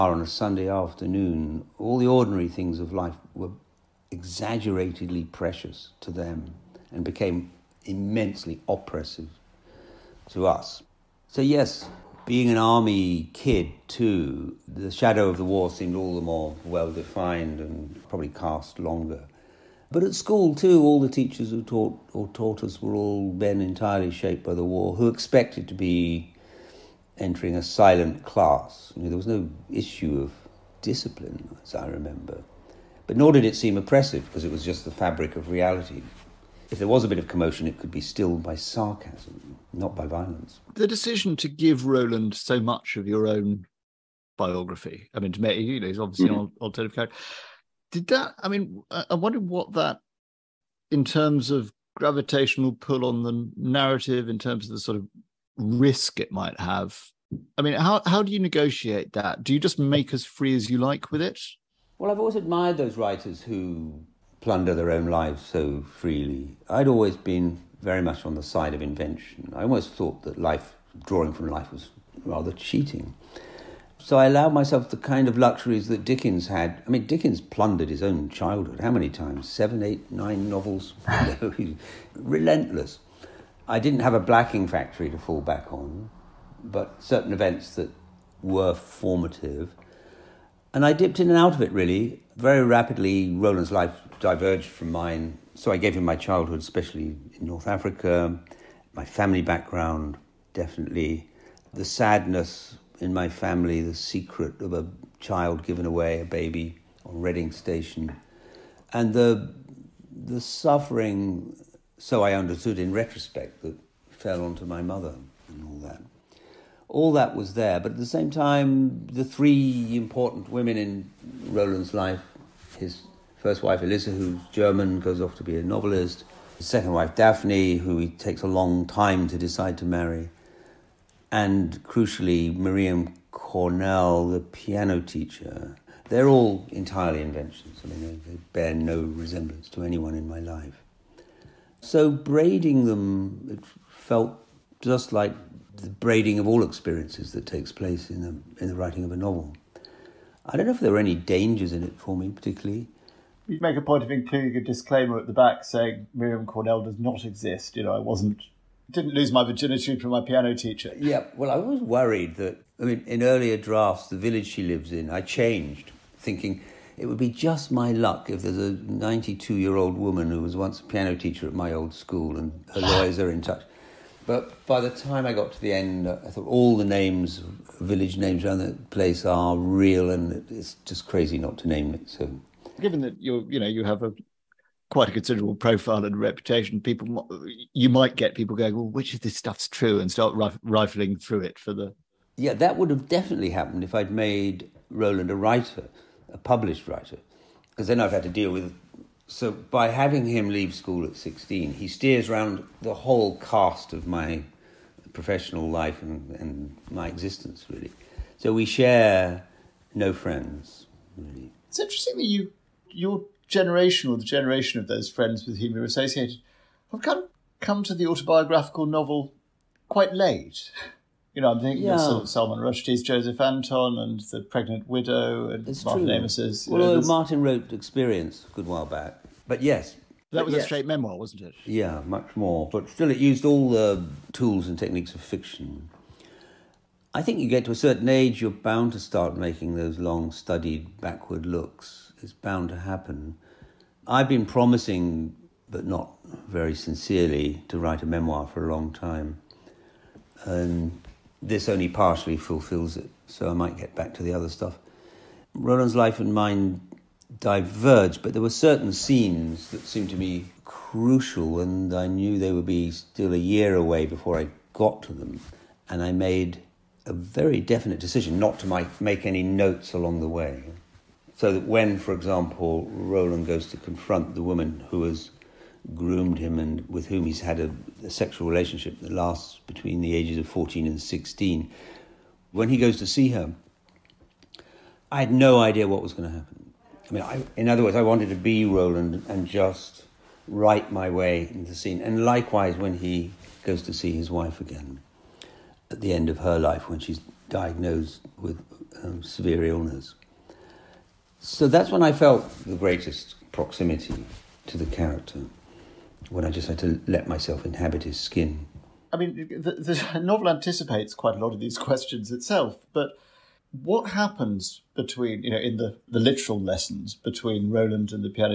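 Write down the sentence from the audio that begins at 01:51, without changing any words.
So I understood in retrospect that fell onto my mother and all that.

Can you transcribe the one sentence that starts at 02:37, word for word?
You know, I wasn't didn't lose my virginity from my piano teacher.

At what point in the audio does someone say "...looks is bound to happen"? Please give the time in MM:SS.
04:01.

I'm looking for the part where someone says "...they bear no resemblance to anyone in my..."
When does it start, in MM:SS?
02:18.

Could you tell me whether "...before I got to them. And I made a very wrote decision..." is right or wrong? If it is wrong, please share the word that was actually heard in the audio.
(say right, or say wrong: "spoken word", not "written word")
wrong: "definite", not "wrote".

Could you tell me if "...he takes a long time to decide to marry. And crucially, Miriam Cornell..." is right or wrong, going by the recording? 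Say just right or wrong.
right.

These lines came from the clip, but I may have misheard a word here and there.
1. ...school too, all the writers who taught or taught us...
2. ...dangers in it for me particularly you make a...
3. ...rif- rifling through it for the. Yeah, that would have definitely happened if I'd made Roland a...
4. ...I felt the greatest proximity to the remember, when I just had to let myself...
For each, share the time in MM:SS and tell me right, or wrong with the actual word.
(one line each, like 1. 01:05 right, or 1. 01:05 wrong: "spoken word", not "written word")
1. 00:20 wrong: "teachers", not "writers"
2. 02:31 right
3. 03:10 right
4. 05:02 wrong: "character", not "remember".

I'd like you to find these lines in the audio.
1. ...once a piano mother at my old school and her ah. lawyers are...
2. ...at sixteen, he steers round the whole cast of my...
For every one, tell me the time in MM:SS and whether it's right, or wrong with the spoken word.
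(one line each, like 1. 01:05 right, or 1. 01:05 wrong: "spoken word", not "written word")
1. 02:50 wrong: "teacher", not "mother"
2. 03:21 right.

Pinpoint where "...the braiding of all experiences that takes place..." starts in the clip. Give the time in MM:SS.
02:25.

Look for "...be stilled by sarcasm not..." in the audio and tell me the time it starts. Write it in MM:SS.
00:37.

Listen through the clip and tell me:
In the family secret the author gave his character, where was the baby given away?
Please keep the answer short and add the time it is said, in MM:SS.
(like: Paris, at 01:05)
Reading Station, at 01:47.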